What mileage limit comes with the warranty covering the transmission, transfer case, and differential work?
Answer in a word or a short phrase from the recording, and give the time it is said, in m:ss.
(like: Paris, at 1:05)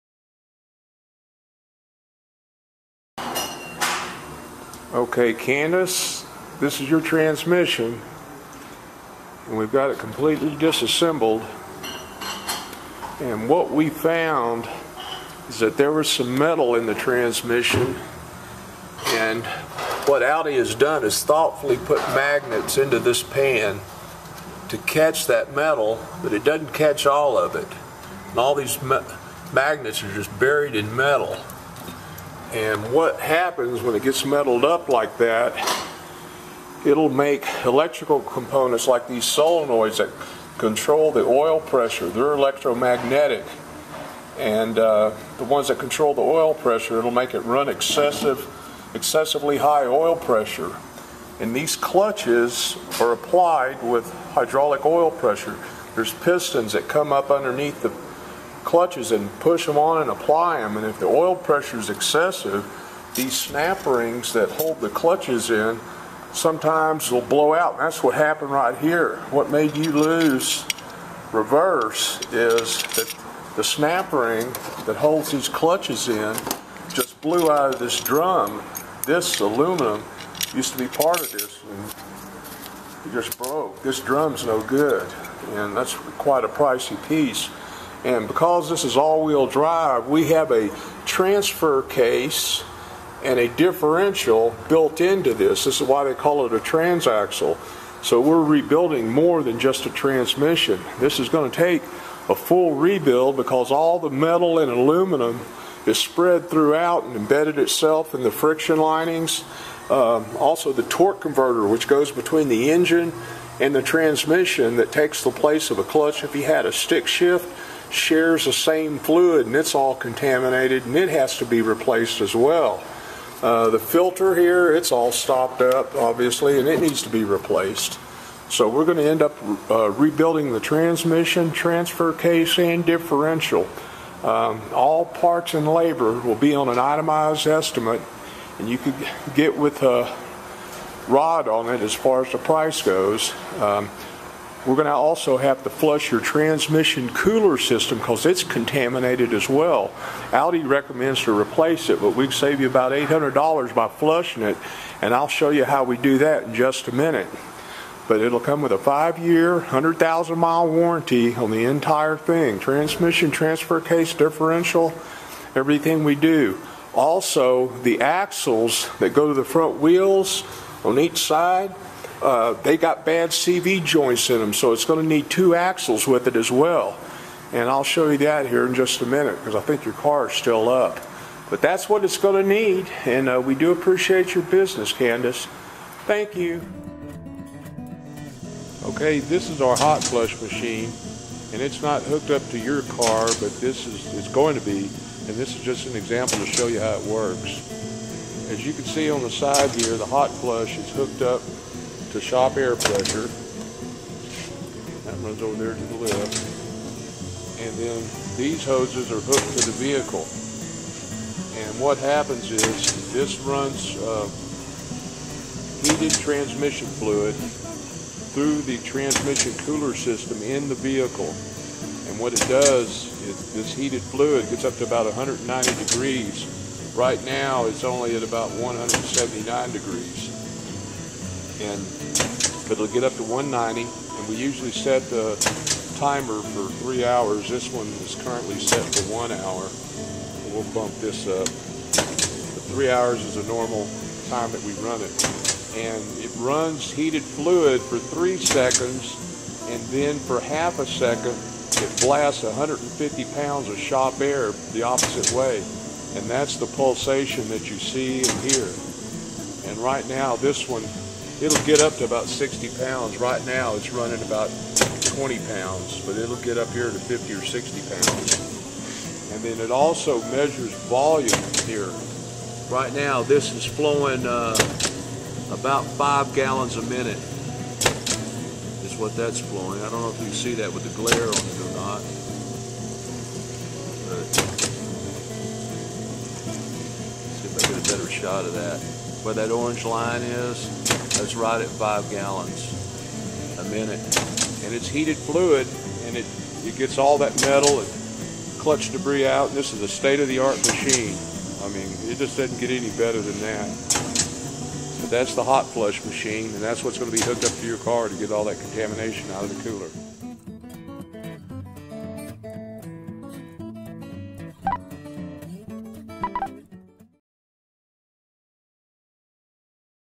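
100,000 miles, at 2:39.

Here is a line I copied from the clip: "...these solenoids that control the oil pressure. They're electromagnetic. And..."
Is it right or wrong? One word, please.
right.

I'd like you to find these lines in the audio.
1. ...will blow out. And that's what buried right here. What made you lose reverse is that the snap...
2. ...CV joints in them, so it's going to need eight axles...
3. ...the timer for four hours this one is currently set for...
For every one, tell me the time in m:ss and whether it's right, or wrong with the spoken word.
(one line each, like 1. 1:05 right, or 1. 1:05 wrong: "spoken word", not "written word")
1. 1:07 wrong: "happened", not "buried"
2. 2:53 wrong: "two", not "eight"
3. 3:55 wrong: "three", not "four".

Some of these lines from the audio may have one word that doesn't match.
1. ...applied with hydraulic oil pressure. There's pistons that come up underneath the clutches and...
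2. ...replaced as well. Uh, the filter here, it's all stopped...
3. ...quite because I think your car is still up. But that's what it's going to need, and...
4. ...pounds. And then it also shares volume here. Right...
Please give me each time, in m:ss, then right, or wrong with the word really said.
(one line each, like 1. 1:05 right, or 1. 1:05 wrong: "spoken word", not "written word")
1. 0:53 right
2. 2:01 right
3. 2:59 wrong: "minute", not "quite"
4. 4:27 wrong: "measures", not "shares".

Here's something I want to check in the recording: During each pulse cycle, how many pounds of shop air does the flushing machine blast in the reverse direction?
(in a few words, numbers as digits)
150 pounds.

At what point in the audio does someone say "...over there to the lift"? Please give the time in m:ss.
3:25.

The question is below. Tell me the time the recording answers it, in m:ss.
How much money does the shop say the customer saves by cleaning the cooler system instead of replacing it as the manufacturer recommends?
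2:32.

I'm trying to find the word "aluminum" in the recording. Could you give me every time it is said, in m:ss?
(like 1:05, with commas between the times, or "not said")
1:19, 1:44.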